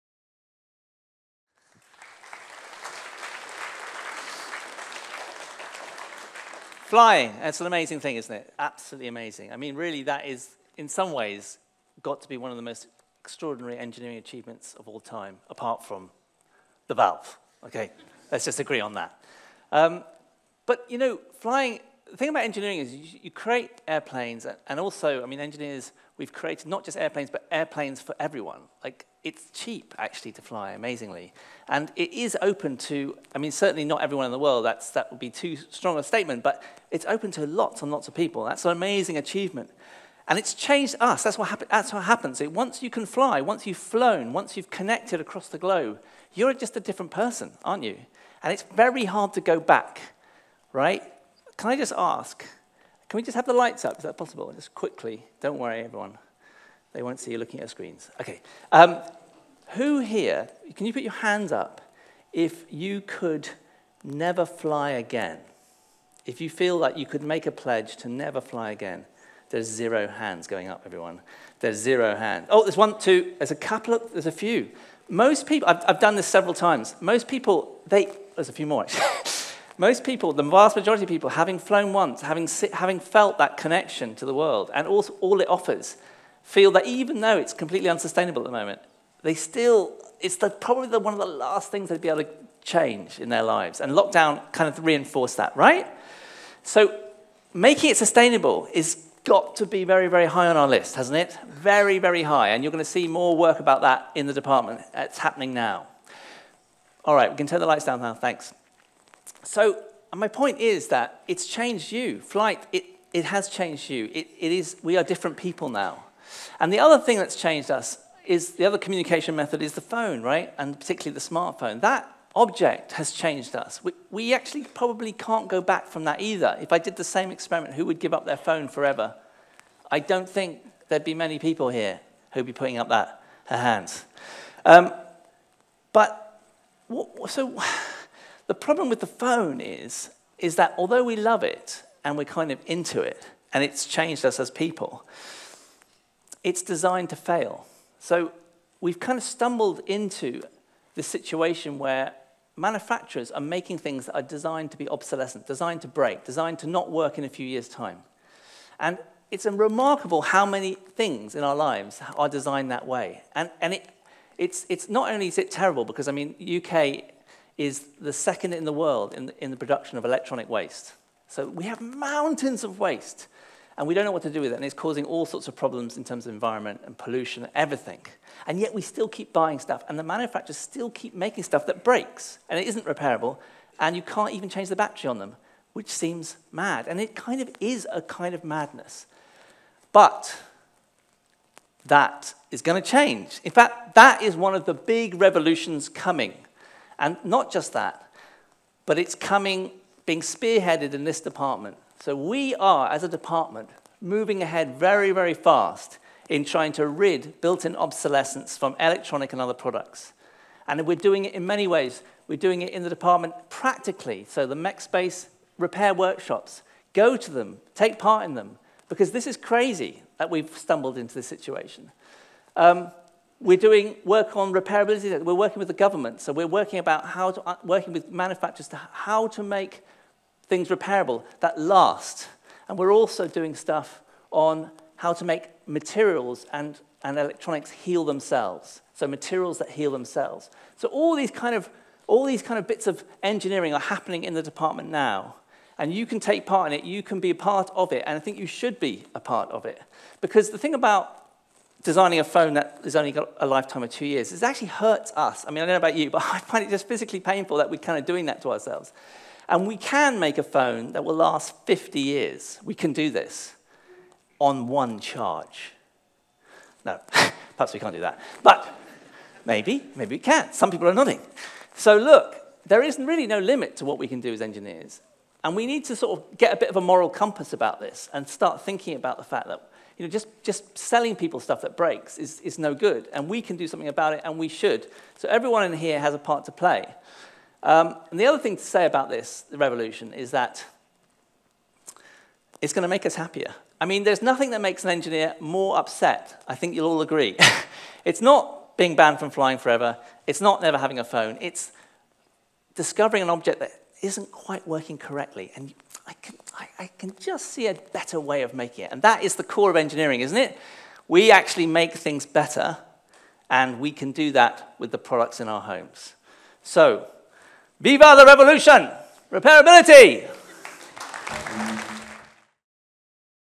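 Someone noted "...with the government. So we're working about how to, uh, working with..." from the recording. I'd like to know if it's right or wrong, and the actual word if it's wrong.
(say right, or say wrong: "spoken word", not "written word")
right.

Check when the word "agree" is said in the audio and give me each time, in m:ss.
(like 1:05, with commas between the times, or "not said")
0:18, 4:57.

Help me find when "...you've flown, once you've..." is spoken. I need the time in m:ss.
0:43.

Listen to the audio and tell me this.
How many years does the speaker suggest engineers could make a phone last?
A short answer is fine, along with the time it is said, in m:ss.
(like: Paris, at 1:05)
50 years, at 4:21.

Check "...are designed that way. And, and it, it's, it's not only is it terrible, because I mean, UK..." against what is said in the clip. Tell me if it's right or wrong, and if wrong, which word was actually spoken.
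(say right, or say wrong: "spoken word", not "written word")
right.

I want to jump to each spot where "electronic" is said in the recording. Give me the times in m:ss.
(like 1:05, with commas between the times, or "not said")
2:50, 3:28, 3:57.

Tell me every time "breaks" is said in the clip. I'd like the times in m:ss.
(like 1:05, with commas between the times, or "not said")
2:35, 3:01, 4:41.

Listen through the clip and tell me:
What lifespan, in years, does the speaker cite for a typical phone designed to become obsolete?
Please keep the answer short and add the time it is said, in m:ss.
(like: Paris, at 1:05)
2 years, at 4:13.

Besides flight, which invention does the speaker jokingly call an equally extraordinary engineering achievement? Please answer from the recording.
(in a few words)
The valve.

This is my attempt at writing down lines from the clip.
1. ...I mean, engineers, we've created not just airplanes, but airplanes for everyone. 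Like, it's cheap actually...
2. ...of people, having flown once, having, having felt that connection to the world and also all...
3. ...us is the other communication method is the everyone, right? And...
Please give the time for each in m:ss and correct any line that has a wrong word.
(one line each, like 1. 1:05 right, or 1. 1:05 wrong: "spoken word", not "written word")
1. 0:25 right
2. 1:21 right
3. 1:57 wrong: "phone", not "everyone".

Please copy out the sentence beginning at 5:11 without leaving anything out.
We actually make things better, and we can do that with the products in our homes.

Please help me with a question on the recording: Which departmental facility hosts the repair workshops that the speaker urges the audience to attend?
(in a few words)
Mech space.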